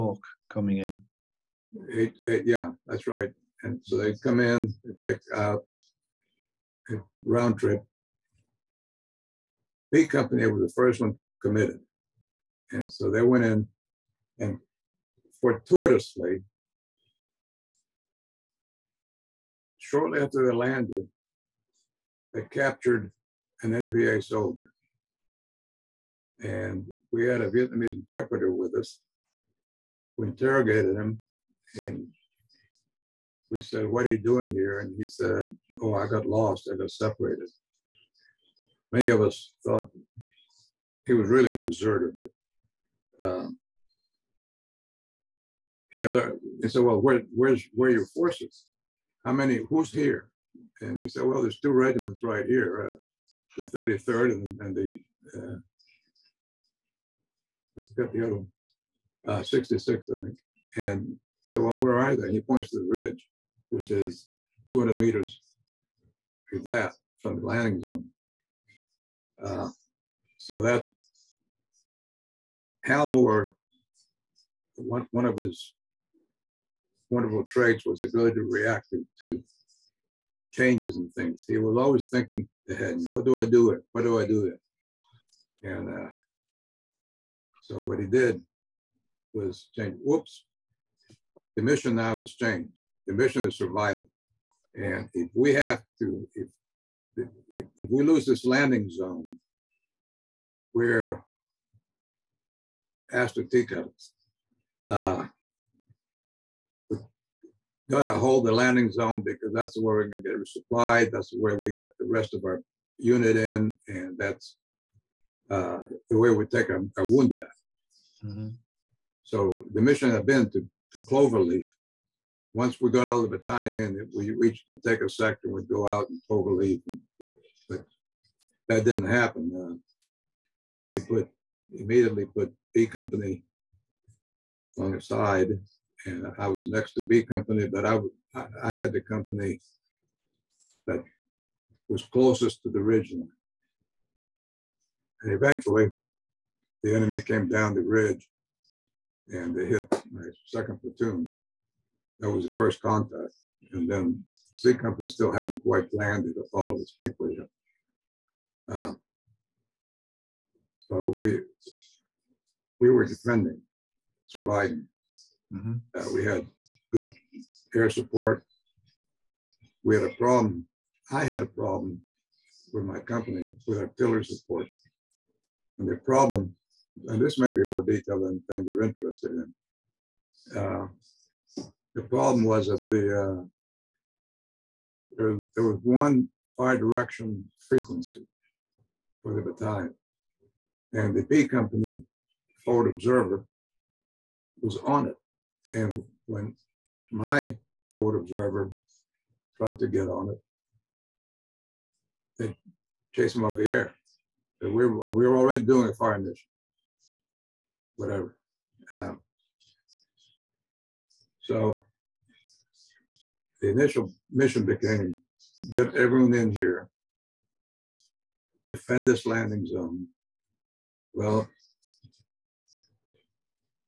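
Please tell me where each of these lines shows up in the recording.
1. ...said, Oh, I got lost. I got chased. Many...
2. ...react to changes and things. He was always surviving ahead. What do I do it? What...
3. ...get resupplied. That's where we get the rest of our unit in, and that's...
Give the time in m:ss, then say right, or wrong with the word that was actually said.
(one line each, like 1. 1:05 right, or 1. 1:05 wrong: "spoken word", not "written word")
1. 0:35 wrong: "separated", not "chased"
2. 1:18 wrong: "thinking", not "surviving"
3. 1:50 right.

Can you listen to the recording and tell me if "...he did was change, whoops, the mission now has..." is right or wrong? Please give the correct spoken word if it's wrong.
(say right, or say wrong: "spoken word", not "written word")
right.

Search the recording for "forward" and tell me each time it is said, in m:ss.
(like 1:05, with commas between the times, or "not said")
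3:12, 3:17.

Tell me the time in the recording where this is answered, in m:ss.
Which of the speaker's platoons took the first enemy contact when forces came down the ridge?
2:30.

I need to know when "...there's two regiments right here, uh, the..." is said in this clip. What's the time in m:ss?
0:51.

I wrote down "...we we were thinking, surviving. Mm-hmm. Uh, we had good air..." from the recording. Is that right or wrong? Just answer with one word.
wrong.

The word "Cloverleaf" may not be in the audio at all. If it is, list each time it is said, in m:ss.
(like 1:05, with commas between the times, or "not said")
2:01, 2:06.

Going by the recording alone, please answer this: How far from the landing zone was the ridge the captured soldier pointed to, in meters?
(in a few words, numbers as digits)
200.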